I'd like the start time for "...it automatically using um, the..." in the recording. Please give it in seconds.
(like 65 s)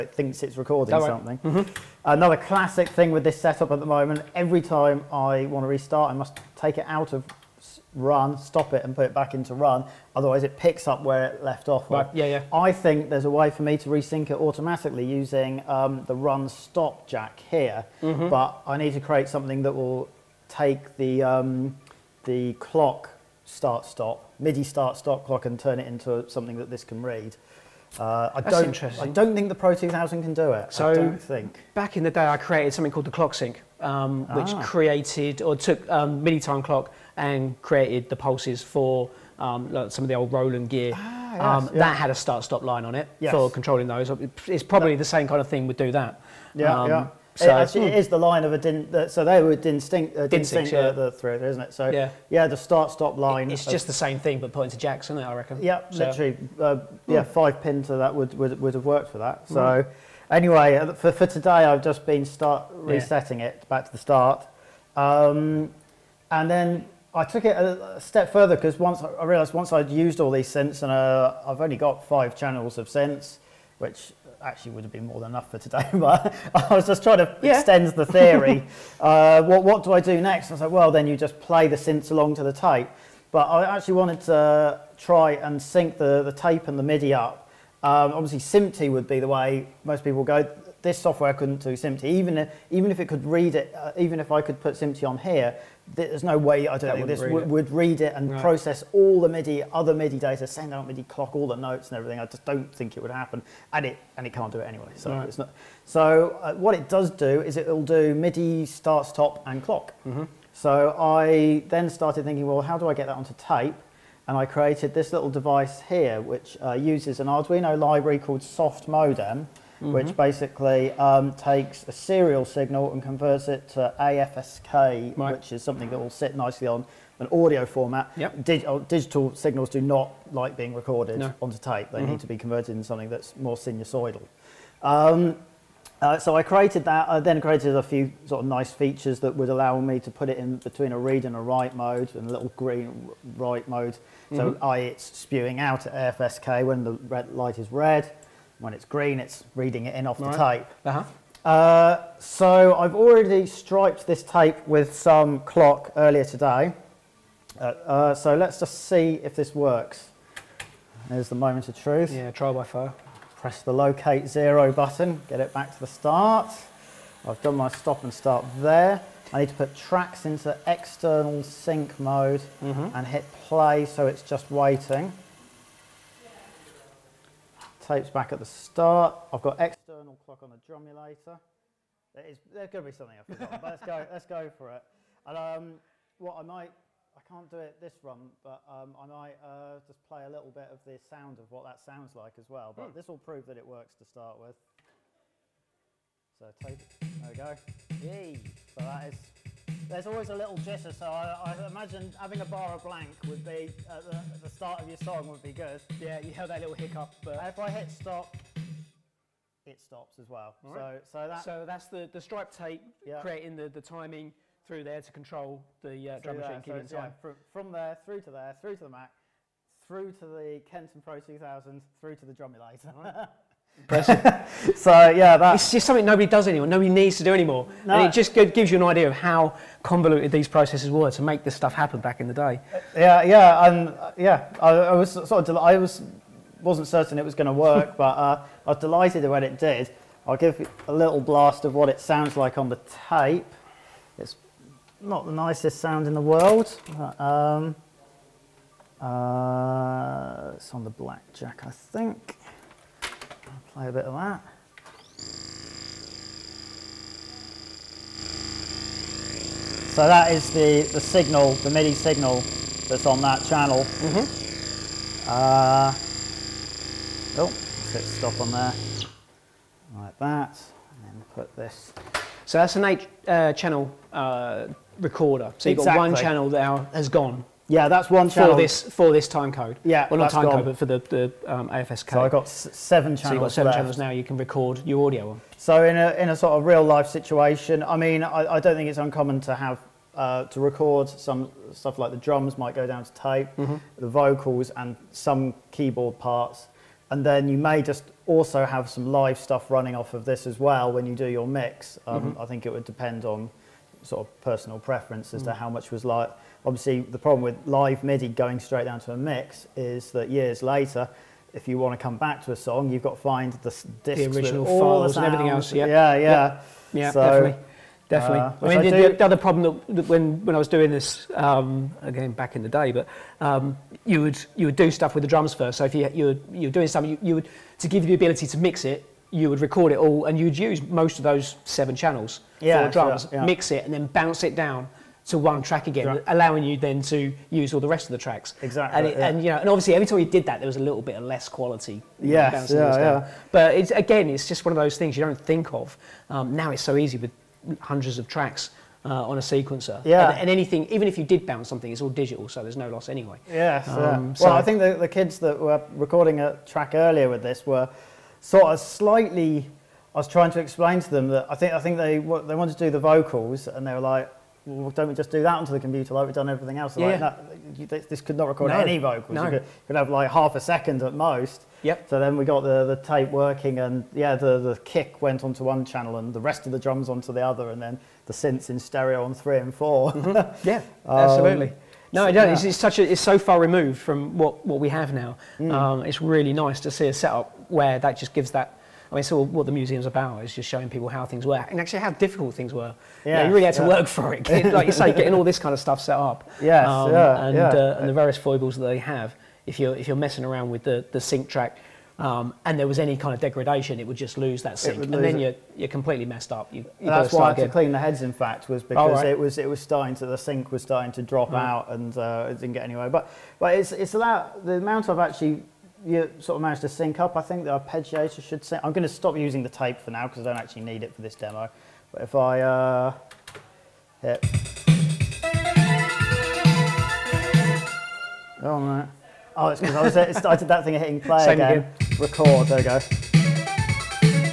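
14 s.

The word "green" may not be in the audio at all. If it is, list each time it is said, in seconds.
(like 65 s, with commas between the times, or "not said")
142 s, 148 s.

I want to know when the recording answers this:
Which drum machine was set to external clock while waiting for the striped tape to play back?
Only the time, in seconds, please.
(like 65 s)
180 s.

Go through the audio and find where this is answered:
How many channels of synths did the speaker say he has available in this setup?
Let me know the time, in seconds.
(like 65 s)
72 s.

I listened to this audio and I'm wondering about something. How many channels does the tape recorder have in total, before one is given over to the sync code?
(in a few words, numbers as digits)
8.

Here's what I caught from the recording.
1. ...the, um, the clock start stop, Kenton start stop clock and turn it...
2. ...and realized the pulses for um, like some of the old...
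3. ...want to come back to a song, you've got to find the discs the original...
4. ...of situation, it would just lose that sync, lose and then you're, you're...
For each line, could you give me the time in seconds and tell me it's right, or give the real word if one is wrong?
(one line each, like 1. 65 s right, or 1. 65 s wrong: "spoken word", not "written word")
1. 20 s wrong: "MIDI", not "Kenton"
2. 37 s wrong: "created", not "realized"
3. 311 s right
4. 403 s wrong: "degradation", not "situation".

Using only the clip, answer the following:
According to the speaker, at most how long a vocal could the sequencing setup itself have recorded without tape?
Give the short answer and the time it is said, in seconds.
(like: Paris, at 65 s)
half a second, at 370 s.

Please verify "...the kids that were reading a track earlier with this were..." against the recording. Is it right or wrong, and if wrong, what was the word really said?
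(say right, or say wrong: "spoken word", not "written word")
wrong: "recording", not "reading".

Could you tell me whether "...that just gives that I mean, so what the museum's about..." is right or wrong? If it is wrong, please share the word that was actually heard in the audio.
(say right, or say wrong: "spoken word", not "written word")
right.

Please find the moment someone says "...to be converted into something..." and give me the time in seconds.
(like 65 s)
132 s.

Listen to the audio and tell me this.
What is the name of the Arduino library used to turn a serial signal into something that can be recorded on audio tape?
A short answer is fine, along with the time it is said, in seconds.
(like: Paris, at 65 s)
Soft Modem, at 118 s.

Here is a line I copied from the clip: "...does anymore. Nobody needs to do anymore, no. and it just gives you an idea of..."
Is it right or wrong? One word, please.
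right.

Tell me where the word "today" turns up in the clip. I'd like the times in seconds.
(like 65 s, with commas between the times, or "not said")
61 s, 75 s, 156 s.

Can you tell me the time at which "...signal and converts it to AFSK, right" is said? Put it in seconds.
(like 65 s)
122 s.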